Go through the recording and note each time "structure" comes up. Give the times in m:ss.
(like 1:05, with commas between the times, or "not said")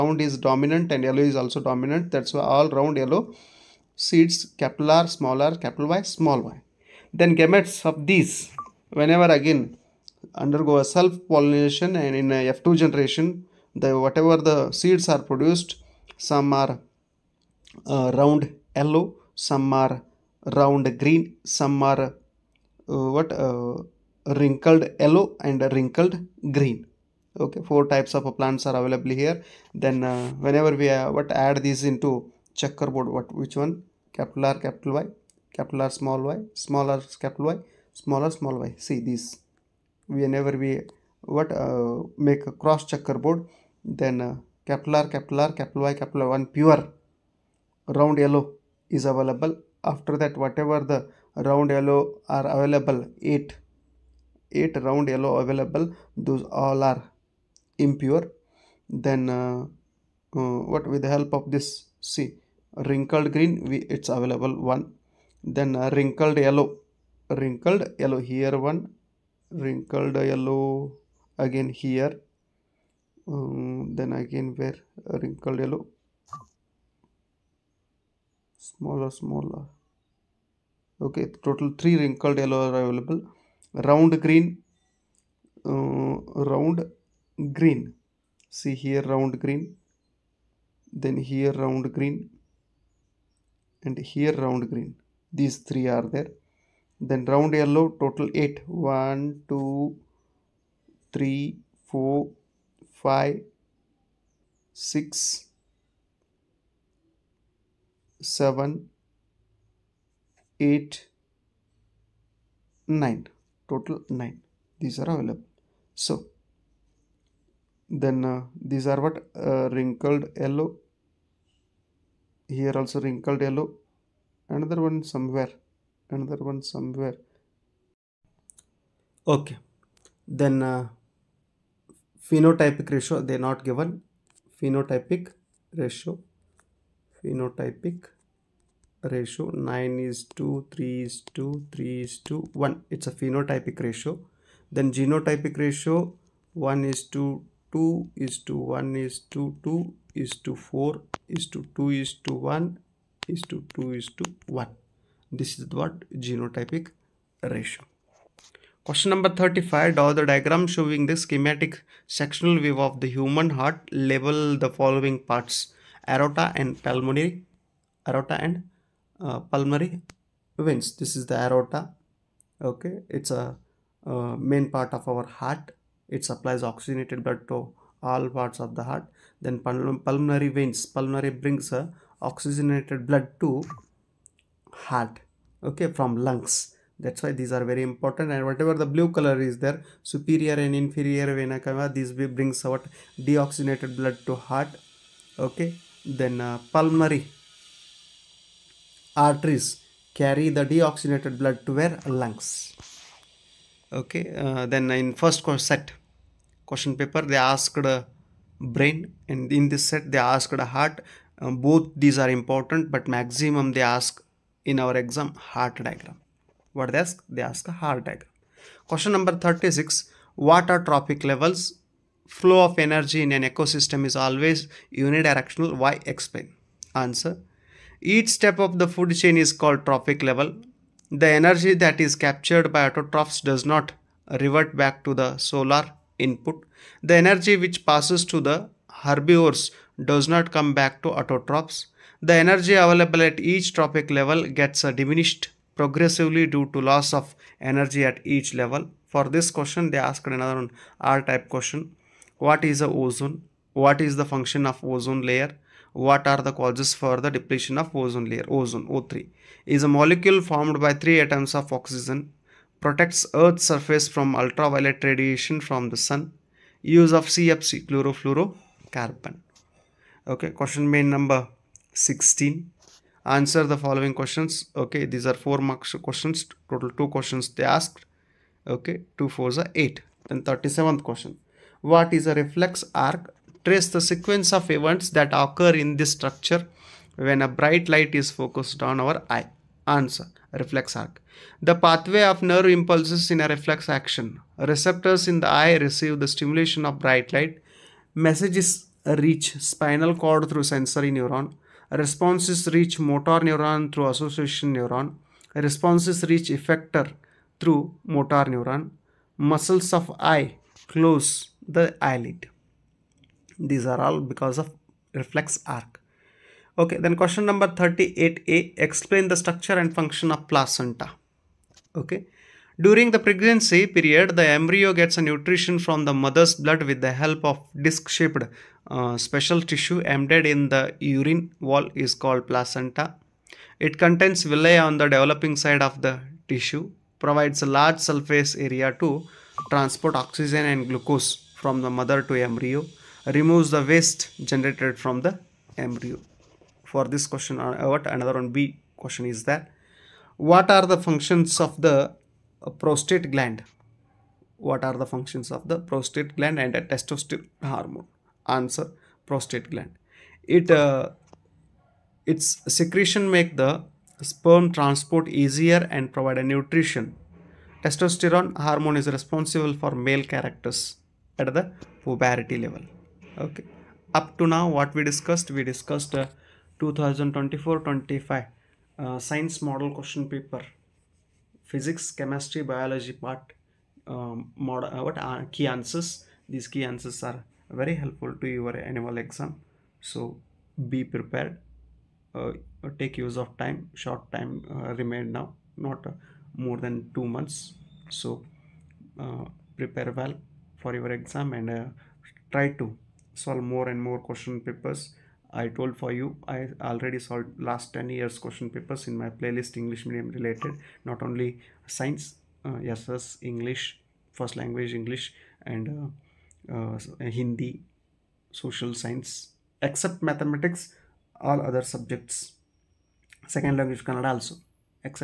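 4:46, 5:19.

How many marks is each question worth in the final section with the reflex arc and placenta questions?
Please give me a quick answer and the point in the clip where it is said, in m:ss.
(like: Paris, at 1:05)
4, at 4:35.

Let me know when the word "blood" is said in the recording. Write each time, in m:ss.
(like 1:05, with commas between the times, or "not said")
2:57, 3:03, 3:14, 3:21, 5:26.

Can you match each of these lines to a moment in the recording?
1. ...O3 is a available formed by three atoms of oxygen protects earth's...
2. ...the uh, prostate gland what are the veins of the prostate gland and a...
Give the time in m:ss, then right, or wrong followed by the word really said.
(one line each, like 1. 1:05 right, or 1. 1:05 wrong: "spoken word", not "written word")
1. 4:18 wrong: "molecule", not "available"
2. 5:51 wrong: "functions", not "veins".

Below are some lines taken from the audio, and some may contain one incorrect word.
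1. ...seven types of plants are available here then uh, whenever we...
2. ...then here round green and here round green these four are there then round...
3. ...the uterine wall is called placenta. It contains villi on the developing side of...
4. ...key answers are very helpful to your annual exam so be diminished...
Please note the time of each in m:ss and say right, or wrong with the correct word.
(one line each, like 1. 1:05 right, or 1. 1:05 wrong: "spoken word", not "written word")
1. 0:27 wrong: "four", not "seven"
2. 1:31 wrong: "three", not "four"
3. 5:30 right
4. 6:26 wrong: "prepared", not "diminished".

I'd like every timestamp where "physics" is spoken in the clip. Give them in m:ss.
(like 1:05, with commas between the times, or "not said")
6:21.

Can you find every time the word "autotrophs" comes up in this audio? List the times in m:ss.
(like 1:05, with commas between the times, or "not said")
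3:52, 4:01.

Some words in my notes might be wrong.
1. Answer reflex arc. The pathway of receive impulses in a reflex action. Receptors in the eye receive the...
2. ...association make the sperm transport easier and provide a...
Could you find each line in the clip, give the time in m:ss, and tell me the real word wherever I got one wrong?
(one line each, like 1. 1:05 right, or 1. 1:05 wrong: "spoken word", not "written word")
1. 4:49 wrong: "nerve", not "receive"
2. 6:02 wrong: "secretion", not "association".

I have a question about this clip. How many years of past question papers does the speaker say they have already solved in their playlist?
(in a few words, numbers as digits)
10.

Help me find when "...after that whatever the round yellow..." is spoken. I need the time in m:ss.
0:49.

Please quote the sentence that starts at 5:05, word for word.
Responses reach effector through motor neuron.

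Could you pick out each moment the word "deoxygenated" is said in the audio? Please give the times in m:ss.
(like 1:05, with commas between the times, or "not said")
3:13, 3:20.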